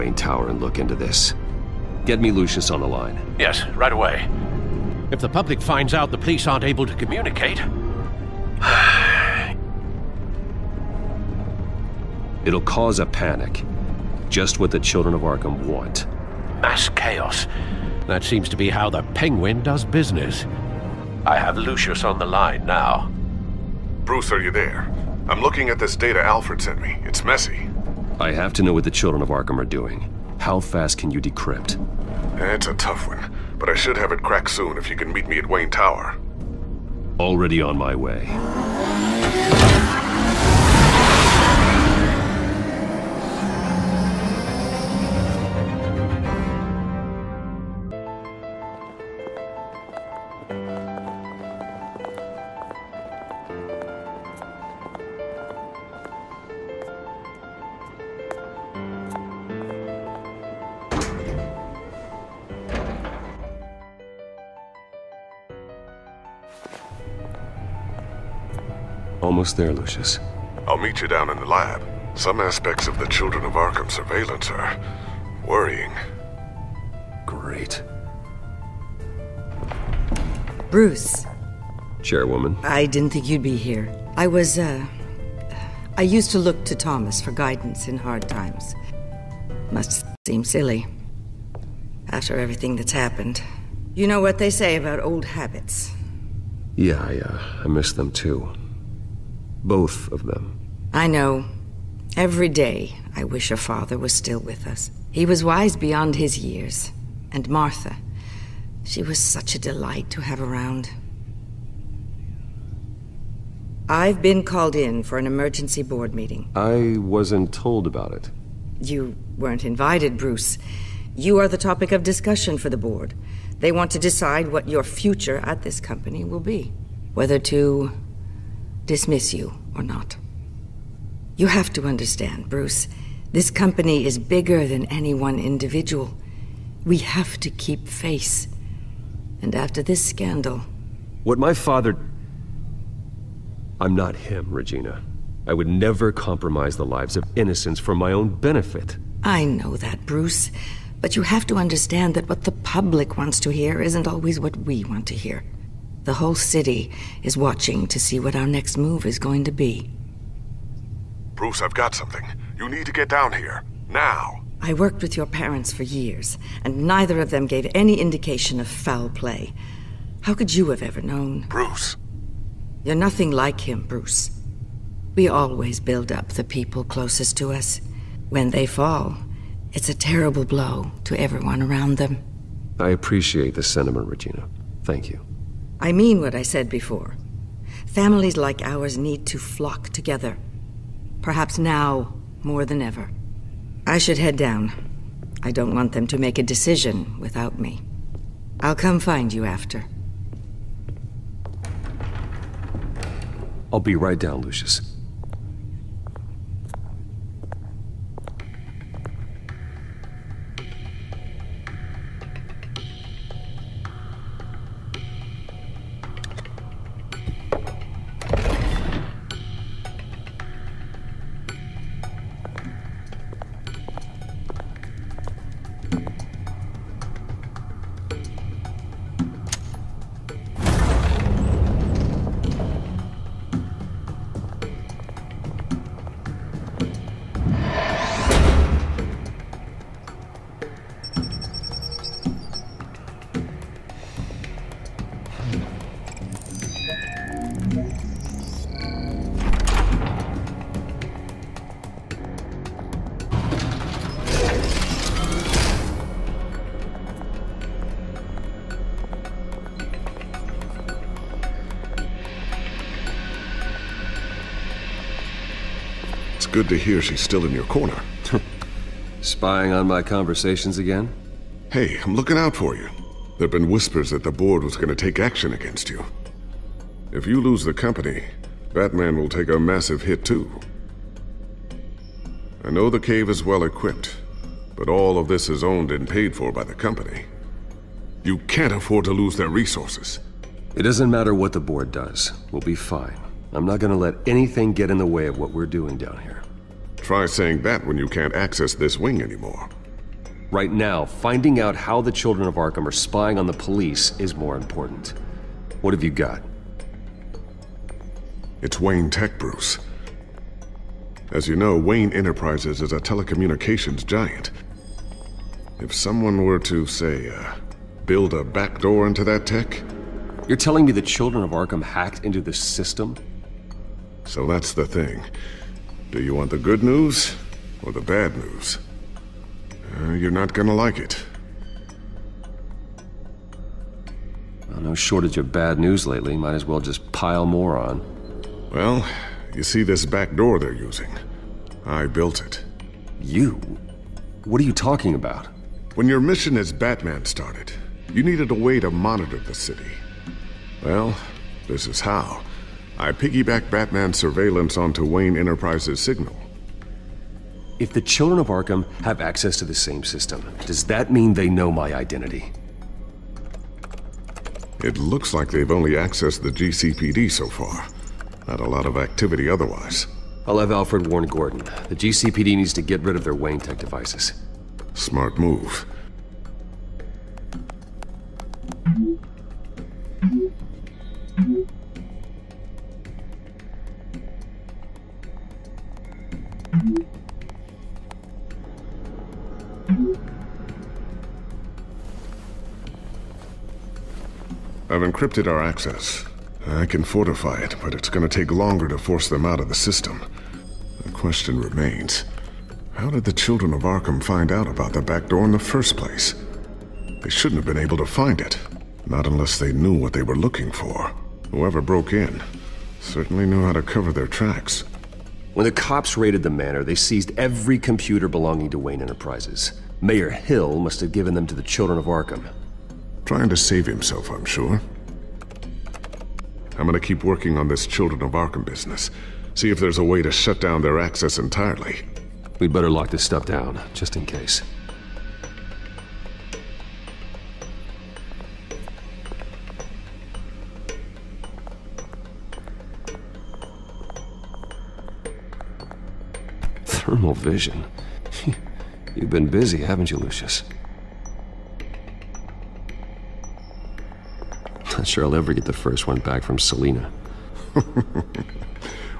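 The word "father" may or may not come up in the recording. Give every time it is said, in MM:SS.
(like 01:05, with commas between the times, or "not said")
01:43, 02:21.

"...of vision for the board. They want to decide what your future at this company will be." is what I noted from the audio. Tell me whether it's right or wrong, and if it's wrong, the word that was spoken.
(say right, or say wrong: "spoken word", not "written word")
wrong: "discussion", not "vision".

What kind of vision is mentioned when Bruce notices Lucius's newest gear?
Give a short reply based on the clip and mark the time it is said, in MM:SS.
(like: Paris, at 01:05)
Thermal vision, at 07:27.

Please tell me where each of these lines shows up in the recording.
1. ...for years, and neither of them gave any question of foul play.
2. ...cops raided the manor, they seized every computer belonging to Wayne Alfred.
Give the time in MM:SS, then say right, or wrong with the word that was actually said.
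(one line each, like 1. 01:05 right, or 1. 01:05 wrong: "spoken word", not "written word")
1. 02:45 wrong: "indication", not "question"
2. 06:55 wrong: "Enterprises", not "Alfred".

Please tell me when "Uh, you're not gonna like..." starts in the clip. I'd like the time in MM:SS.
05:29.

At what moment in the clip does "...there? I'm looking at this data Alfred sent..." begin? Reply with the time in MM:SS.
00:24.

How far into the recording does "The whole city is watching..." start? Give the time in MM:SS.
02:36.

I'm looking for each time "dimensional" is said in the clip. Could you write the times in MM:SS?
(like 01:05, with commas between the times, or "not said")
not said.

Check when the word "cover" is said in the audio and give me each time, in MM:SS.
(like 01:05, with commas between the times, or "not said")
06:53.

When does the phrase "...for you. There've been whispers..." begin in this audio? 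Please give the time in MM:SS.
04:32.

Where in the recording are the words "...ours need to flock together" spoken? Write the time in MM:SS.
03:08.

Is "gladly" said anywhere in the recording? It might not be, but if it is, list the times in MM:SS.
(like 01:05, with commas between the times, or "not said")
not said.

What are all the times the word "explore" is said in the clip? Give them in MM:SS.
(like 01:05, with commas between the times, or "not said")
not said.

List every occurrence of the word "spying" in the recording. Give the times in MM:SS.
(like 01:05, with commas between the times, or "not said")
04:29, 05:02.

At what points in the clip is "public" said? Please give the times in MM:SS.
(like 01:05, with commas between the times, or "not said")
00:05, 02:32.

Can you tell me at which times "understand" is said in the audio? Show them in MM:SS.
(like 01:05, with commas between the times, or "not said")
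02:11, 02:31.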